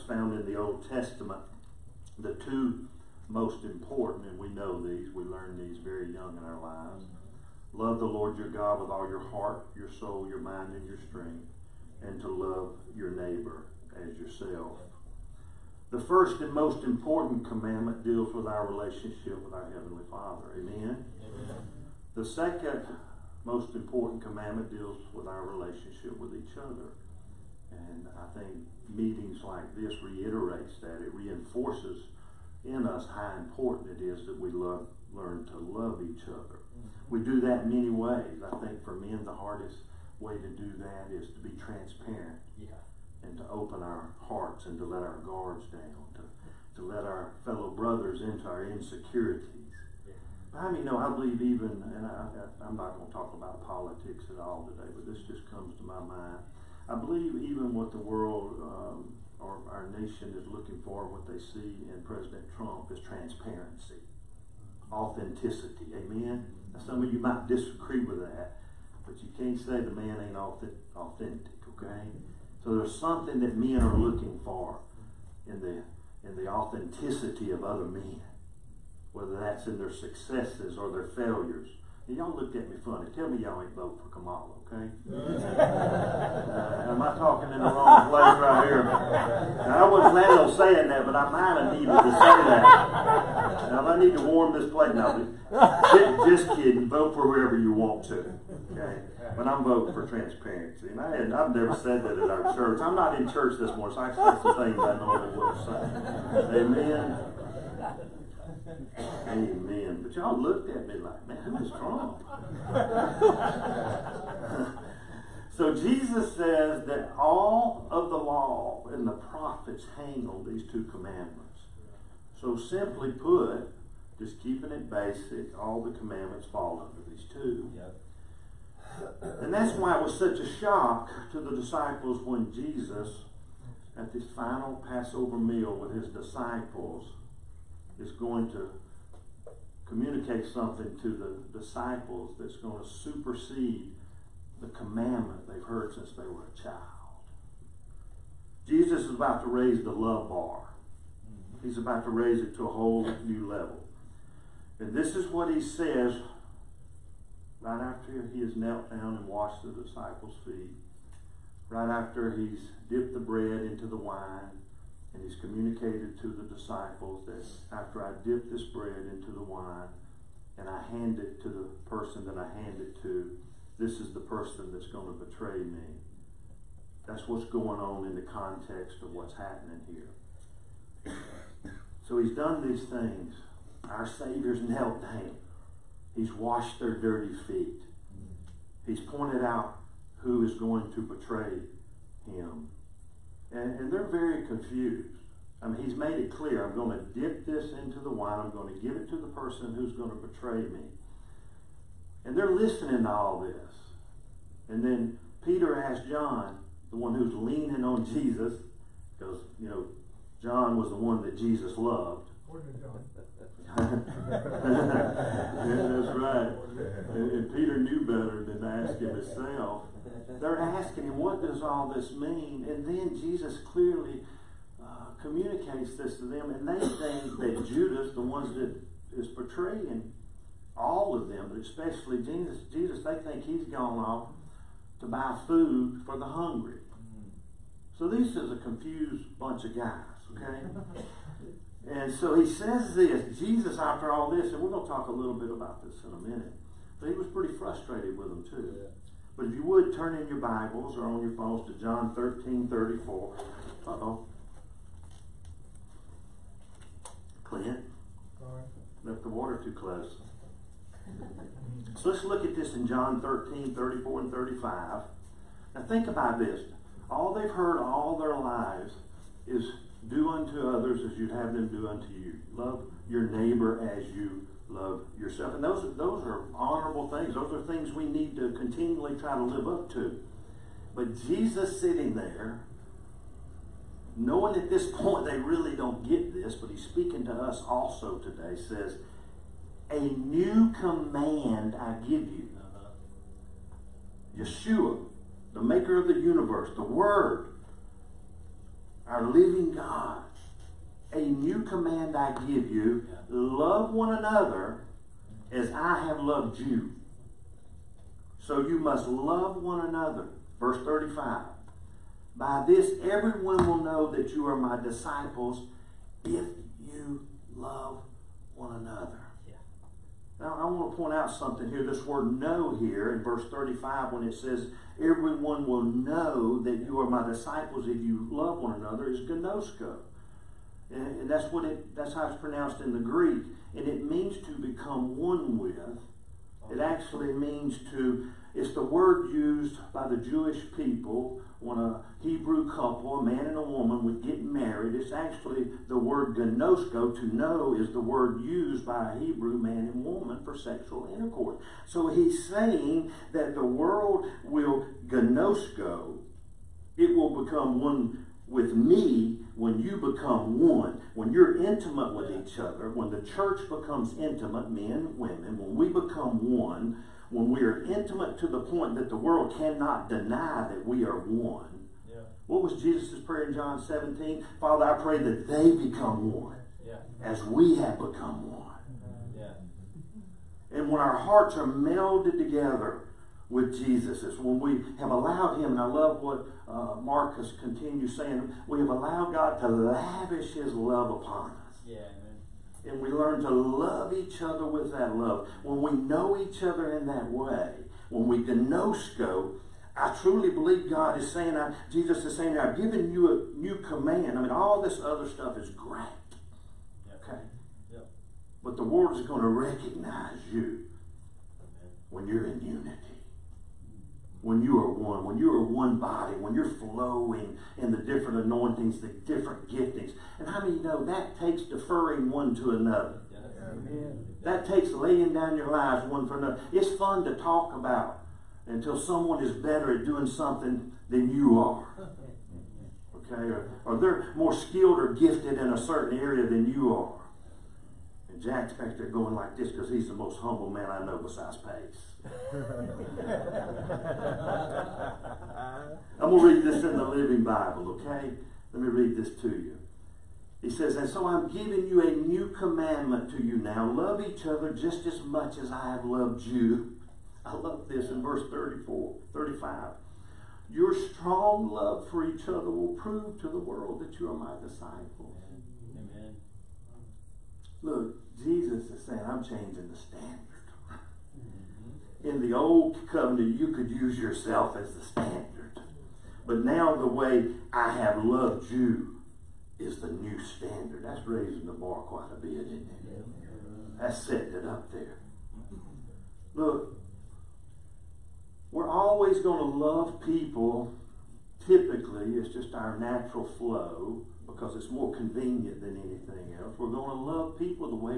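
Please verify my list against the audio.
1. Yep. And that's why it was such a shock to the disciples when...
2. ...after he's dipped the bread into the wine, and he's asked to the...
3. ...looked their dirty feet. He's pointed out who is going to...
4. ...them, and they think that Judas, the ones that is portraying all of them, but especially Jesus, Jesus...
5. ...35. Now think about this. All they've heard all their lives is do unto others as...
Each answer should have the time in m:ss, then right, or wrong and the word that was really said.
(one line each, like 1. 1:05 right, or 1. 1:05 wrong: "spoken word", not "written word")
1. 2:07 right
2. 2:41 wrong: "communicated", not "asked"
3. 3:06 wrong: "washed", not "looked"
4. 3:46 right
5. 4:24 right.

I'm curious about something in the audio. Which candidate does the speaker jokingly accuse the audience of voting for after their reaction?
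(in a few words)
Kamala.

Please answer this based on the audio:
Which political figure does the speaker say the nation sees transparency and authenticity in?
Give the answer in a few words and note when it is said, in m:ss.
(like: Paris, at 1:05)
President Trump, at 1:02.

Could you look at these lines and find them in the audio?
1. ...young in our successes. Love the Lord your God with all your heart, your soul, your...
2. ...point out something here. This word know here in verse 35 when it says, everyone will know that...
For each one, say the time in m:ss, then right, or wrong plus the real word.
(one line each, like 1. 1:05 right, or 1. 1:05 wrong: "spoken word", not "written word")
1. 0:06 wrong: "lives", not "successes"
2. 5:20 right.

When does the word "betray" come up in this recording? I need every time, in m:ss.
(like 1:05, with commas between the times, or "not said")
2:55, 3:11, 3:20.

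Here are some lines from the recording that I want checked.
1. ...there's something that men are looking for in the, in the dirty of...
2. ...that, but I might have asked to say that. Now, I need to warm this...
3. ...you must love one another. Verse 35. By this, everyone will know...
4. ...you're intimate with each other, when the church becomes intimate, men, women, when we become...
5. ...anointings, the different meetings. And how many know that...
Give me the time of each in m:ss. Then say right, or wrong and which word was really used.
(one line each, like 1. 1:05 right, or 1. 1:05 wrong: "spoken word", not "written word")
1. 1:12 wrong: "authenticity", not "dirty"
2. 1:30 wrong: "needed", not "asked"
3. 5:08 right
4. 6:01 right
5. 6:58 wrong: "giftings", not "meetings".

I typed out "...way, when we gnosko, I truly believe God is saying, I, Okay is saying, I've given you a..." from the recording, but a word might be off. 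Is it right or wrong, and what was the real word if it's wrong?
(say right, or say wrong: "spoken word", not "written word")
wrong: "Jesus", not "Okay".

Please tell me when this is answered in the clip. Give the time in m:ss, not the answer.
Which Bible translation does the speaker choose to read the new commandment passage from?
7:27.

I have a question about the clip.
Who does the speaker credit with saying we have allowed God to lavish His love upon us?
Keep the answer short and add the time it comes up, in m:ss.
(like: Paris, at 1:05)
Marcus, at 6:26.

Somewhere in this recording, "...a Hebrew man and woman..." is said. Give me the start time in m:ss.
5:49.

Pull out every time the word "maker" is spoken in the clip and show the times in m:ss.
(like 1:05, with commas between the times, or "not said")
4:55.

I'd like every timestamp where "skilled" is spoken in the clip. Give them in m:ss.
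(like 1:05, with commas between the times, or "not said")
7:14.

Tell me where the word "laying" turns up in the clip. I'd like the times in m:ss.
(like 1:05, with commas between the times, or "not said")
7:04.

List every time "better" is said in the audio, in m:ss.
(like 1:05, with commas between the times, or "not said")
3:38, 7:09.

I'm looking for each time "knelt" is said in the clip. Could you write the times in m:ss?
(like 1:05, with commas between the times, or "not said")
2:38, 3:04.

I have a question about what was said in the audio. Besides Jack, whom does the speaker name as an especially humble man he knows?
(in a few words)
Pace.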